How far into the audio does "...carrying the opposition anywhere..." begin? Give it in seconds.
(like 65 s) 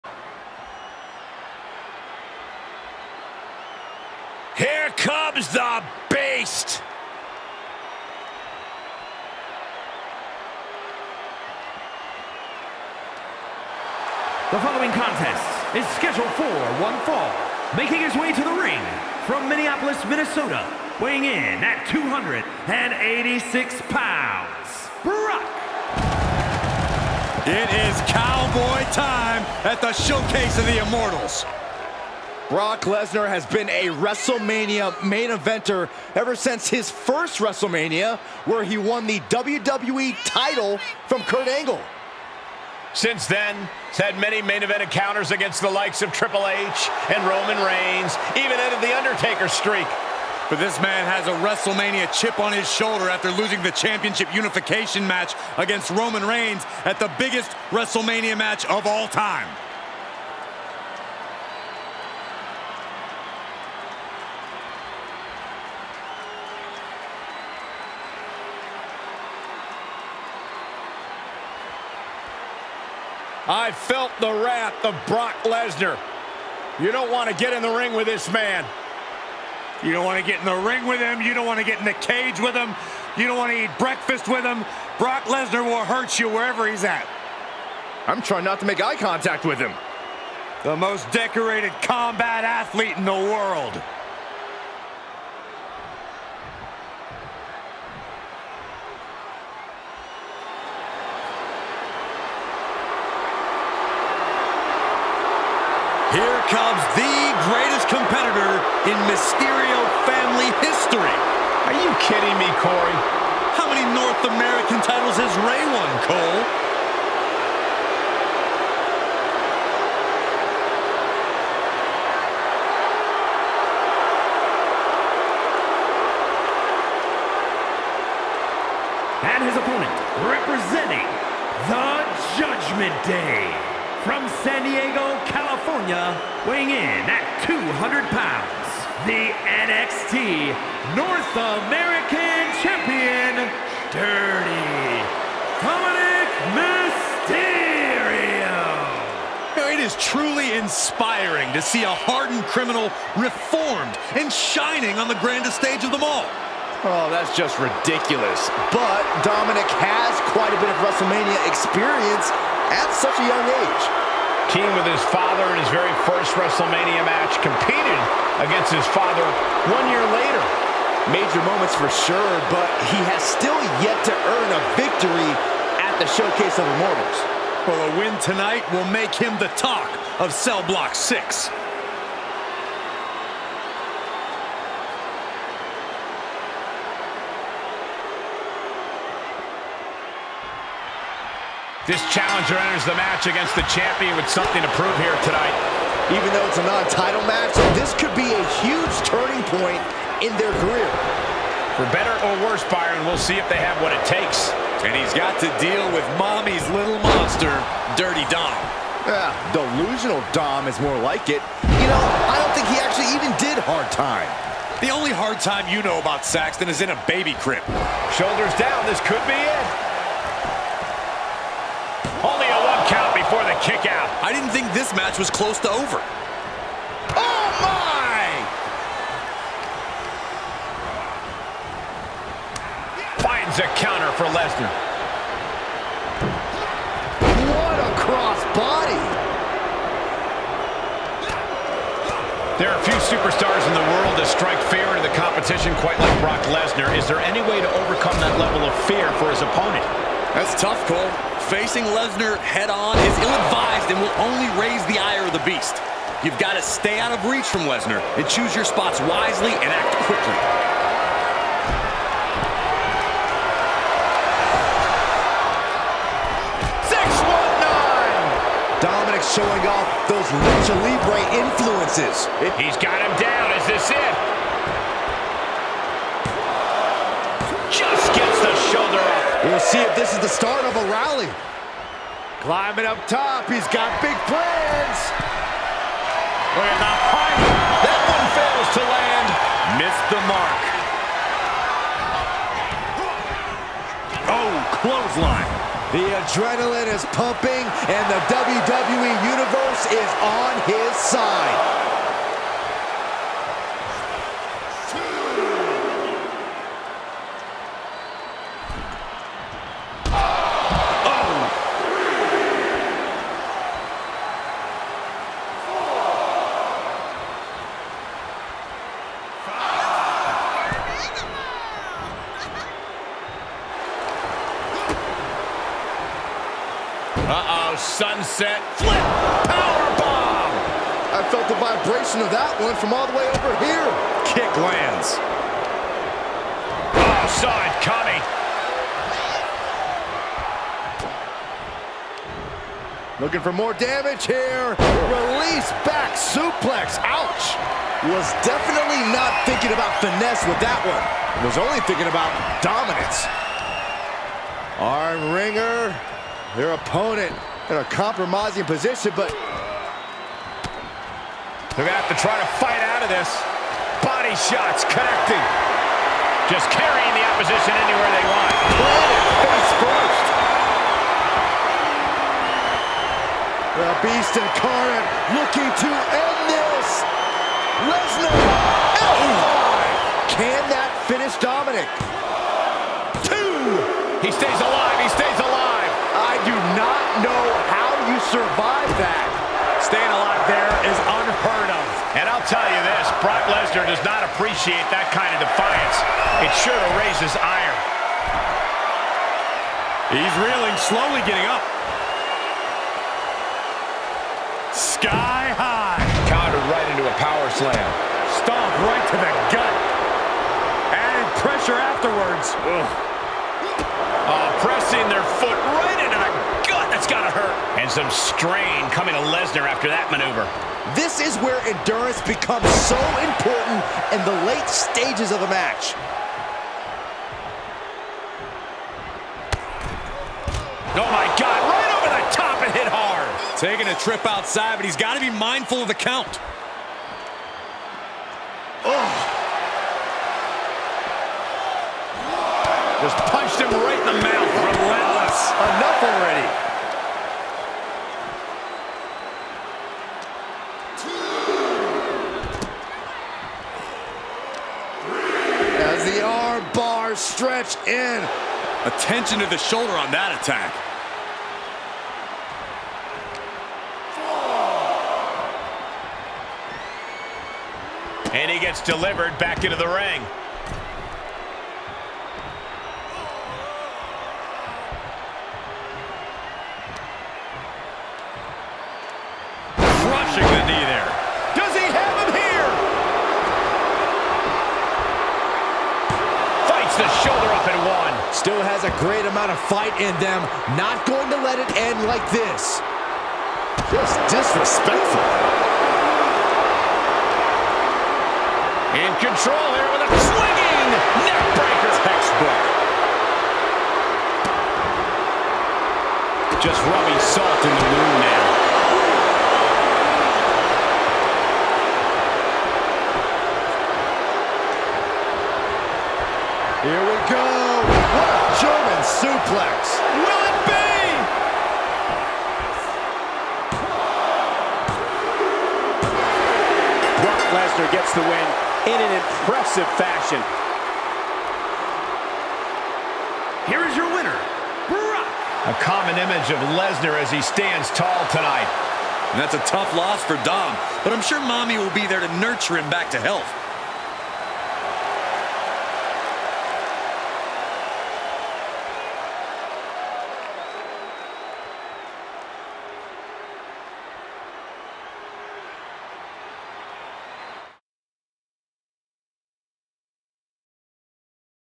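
366 s.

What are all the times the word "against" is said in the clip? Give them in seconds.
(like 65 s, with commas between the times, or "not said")
45 s, 55 s, 168 s, 193 s.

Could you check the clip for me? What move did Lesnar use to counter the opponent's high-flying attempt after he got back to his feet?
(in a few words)
Power slam.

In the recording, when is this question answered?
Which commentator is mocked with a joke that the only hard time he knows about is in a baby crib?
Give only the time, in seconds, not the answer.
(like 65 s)
216 s.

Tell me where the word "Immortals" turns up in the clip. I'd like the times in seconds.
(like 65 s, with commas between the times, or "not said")
30 s, 176 s.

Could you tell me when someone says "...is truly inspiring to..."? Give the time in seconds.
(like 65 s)
149 s.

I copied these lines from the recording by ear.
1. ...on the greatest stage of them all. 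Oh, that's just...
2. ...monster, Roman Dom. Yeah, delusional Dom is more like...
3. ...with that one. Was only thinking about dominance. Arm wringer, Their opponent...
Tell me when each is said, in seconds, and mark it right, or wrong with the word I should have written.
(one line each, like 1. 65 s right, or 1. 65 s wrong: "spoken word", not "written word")
1. 154 s wrong: "grandest", not "greatest"
2. 207 s wrong: "Dirty", not "Roman"
3. 350 s right.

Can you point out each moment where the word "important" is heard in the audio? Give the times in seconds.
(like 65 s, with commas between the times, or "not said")
423 s.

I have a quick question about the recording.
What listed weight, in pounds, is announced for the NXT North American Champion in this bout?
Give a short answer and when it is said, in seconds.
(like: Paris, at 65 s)
200, at 137 s.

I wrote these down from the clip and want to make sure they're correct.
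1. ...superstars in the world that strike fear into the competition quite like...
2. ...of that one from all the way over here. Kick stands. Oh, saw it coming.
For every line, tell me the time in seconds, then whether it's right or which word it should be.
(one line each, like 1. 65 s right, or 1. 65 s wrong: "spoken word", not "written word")
1. 243 s right
2. 332 s wrong: "lands", not "stands".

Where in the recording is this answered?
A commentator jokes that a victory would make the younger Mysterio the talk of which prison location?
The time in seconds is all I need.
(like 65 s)
180 s.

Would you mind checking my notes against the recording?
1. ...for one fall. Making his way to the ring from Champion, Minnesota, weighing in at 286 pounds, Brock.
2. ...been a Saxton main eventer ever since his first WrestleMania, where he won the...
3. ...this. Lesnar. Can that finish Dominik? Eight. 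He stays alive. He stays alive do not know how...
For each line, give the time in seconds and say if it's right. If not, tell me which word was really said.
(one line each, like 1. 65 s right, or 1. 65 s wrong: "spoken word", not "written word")
1. 16 s wrong: "Minneapolis", not "Champion"
2. 33 s wrong: "WrestleMania", not "Saxton"
3. 376 s wrong: "Two", not "Eight".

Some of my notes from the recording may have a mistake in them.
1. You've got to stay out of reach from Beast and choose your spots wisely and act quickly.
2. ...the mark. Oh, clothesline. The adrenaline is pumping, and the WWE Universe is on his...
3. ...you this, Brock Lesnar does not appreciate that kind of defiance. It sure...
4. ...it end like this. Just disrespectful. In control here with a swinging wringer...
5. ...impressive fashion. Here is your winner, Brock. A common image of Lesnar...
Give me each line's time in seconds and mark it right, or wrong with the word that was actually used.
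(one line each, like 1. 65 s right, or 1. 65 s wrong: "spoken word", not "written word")
1. 256 s wrong: "Lesnar", not "Beast"
2. 294 s right
3. 392 s right
4. 491 s wrong: "neckbreaker", not "wringer"
5. 529 s right.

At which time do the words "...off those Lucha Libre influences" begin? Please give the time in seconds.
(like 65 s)
269 s.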